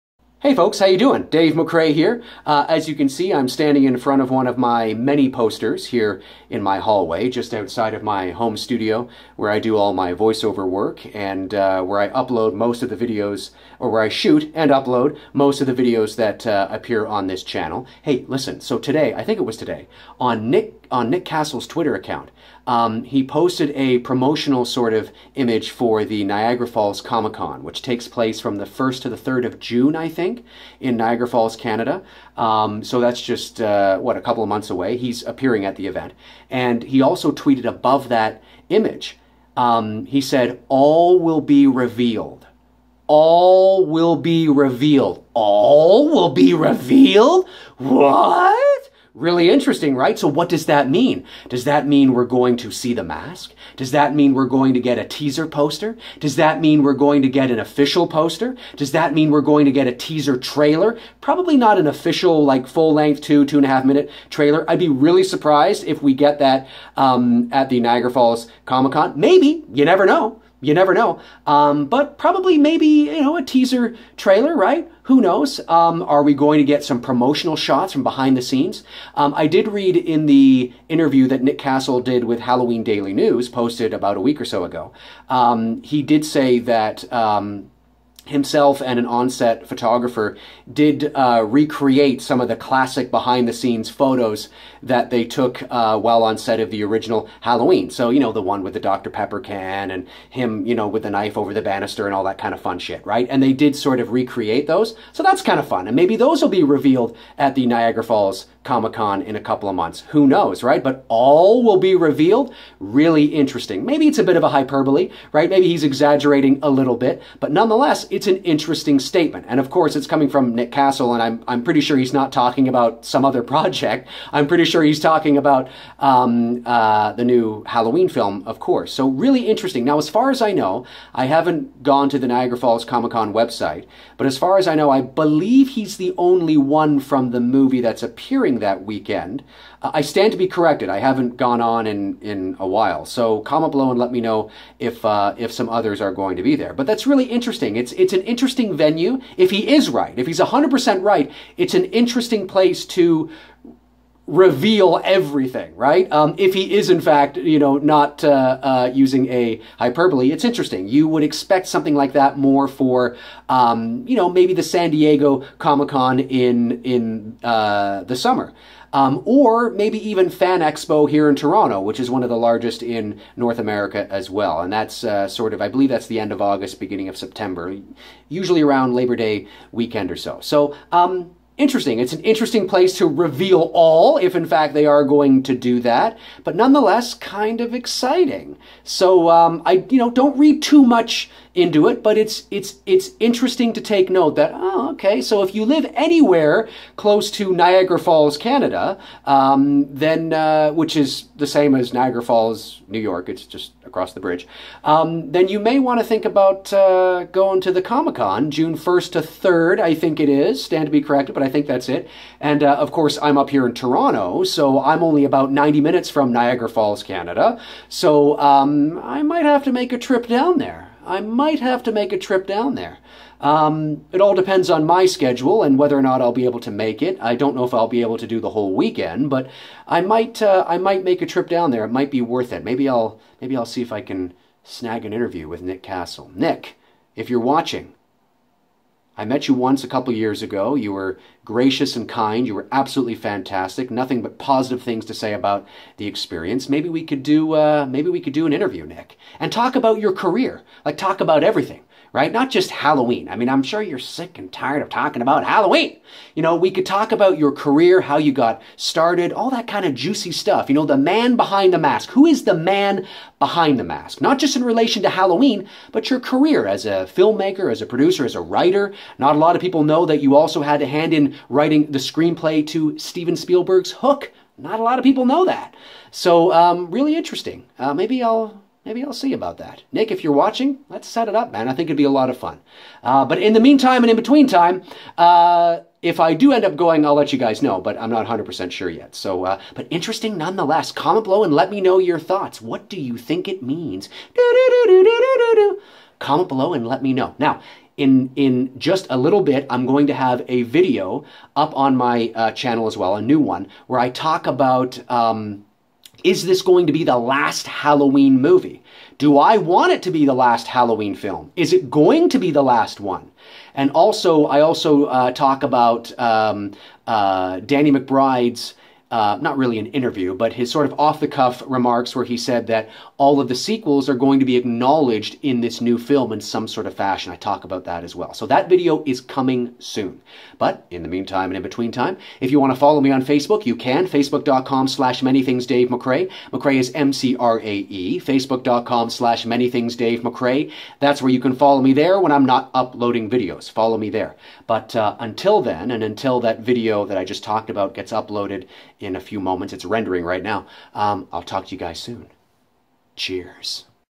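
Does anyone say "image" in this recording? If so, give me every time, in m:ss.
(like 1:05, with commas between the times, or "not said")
0:25, 0:38.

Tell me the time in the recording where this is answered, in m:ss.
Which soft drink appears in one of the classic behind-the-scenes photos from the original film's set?
1:38.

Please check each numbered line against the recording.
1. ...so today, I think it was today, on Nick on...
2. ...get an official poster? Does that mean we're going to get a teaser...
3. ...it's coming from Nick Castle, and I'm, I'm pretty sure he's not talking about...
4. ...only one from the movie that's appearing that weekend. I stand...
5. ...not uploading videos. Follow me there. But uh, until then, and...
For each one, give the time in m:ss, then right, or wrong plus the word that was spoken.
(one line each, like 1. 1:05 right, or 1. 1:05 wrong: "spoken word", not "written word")
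1. 0:18 right
2. 0:57 right
3. 1:59 right
4. 2:16 right
5. 5:42 right.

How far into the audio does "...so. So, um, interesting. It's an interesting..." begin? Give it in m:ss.
3:00.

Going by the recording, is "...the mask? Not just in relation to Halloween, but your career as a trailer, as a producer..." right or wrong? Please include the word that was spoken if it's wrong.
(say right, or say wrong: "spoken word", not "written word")
wrong: "filmmaker", not "trailer".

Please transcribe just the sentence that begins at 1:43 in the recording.
And they did sort of recreate those.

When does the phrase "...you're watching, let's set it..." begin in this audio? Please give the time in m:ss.
4:40.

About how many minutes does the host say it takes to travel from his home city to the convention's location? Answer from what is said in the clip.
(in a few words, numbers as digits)
90.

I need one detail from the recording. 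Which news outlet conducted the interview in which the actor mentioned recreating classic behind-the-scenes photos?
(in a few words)
Halloween Daily News.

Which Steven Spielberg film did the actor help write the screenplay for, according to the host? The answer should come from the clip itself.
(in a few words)
Hook.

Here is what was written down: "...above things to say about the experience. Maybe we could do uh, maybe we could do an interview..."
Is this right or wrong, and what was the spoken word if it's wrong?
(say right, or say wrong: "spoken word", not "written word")
wrong: "positive", not "above".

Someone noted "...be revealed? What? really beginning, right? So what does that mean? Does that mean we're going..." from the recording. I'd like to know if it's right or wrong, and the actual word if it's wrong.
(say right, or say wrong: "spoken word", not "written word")
wrong: "interesting", not "beginning".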